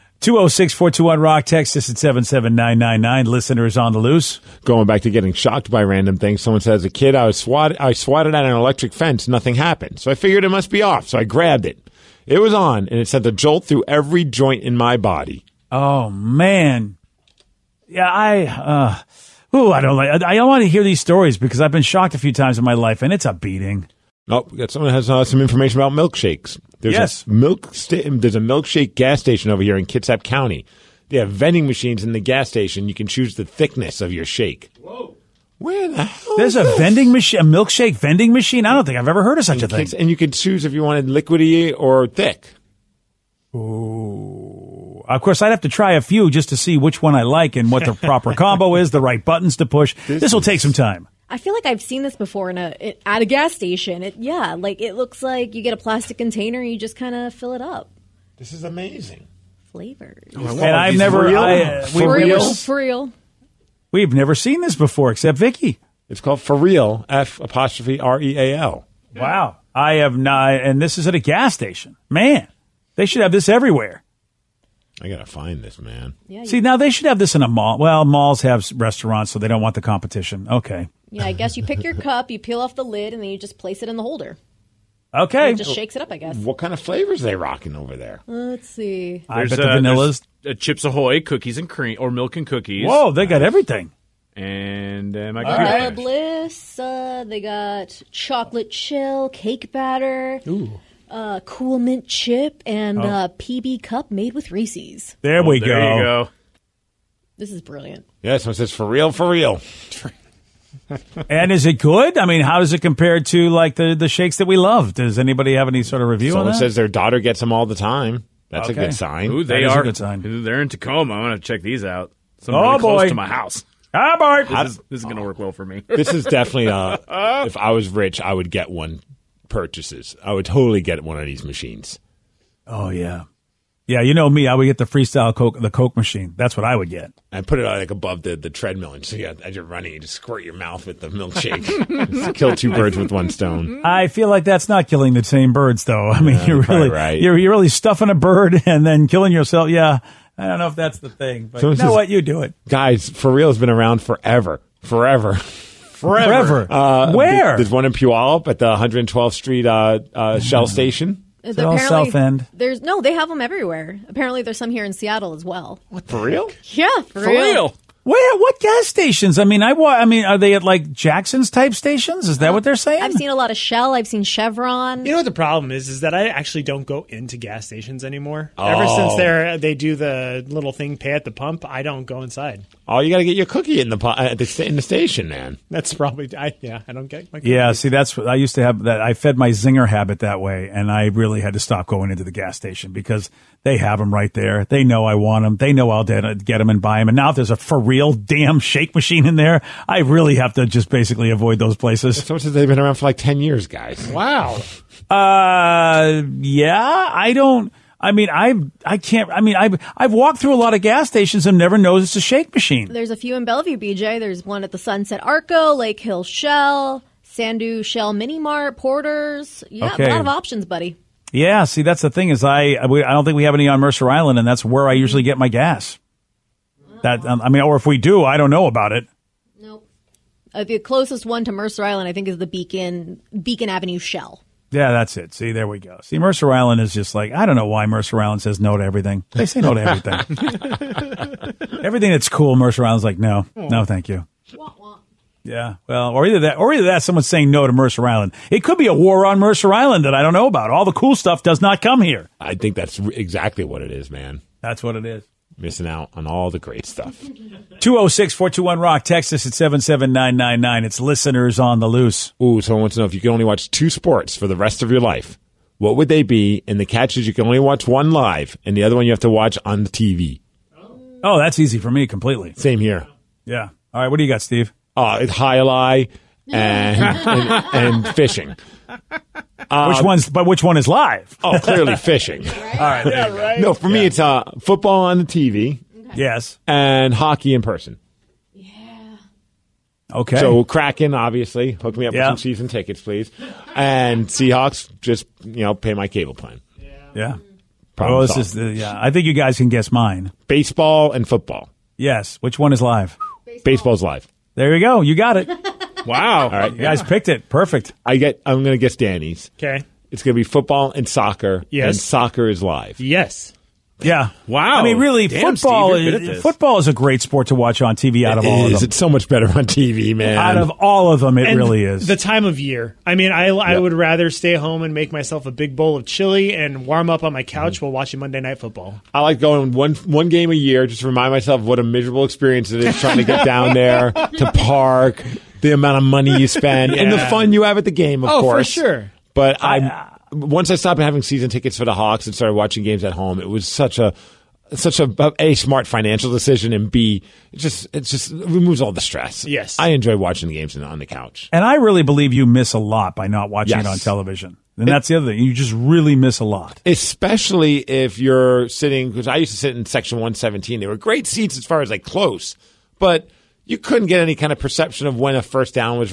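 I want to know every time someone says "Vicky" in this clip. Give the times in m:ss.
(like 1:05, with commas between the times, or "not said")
1:05.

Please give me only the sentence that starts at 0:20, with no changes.
I, I want to hear these stories because I've been shocked a few times in my life, and it's a beating.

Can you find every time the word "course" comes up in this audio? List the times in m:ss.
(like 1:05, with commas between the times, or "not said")
0:45, 5:38.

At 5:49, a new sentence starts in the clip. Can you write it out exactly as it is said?
Yes, I enjoy watching the games on the couch, and I really believe you miss a lot by not watching yes.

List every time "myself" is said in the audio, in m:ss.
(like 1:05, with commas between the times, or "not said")
5:25, 5:31.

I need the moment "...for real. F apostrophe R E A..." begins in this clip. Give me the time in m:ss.
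1:06.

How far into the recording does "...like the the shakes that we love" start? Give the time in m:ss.
1:53.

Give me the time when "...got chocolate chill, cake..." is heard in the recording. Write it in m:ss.
1:37.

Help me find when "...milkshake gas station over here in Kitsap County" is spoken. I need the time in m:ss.
0:28.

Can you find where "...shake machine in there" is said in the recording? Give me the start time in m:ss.
3:18.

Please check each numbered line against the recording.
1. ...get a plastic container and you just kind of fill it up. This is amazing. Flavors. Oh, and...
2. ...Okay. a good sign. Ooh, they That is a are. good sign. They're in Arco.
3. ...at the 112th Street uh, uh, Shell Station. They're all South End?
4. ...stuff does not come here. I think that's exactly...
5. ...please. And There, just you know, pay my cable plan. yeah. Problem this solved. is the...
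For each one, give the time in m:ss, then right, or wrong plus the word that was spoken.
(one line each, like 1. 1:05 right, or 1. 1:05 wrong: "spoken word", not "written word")
1. 0:55 right
2. 1:58 wrong: "Tacoma", not "Arco"
3. 2:38 right
4. 4:11 right
5. 4:53 wrong: "Seahawks", not "There".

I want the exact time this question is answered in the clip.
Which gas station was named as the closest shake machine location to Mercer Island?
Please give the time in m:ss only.
3:53.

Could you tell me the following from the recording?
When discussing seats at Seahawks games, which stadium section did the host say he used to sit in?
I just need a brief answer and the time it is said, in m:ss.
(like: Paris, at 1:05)
117, at 5:59.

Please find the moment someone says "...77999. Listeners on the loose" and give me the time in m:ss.
0:01.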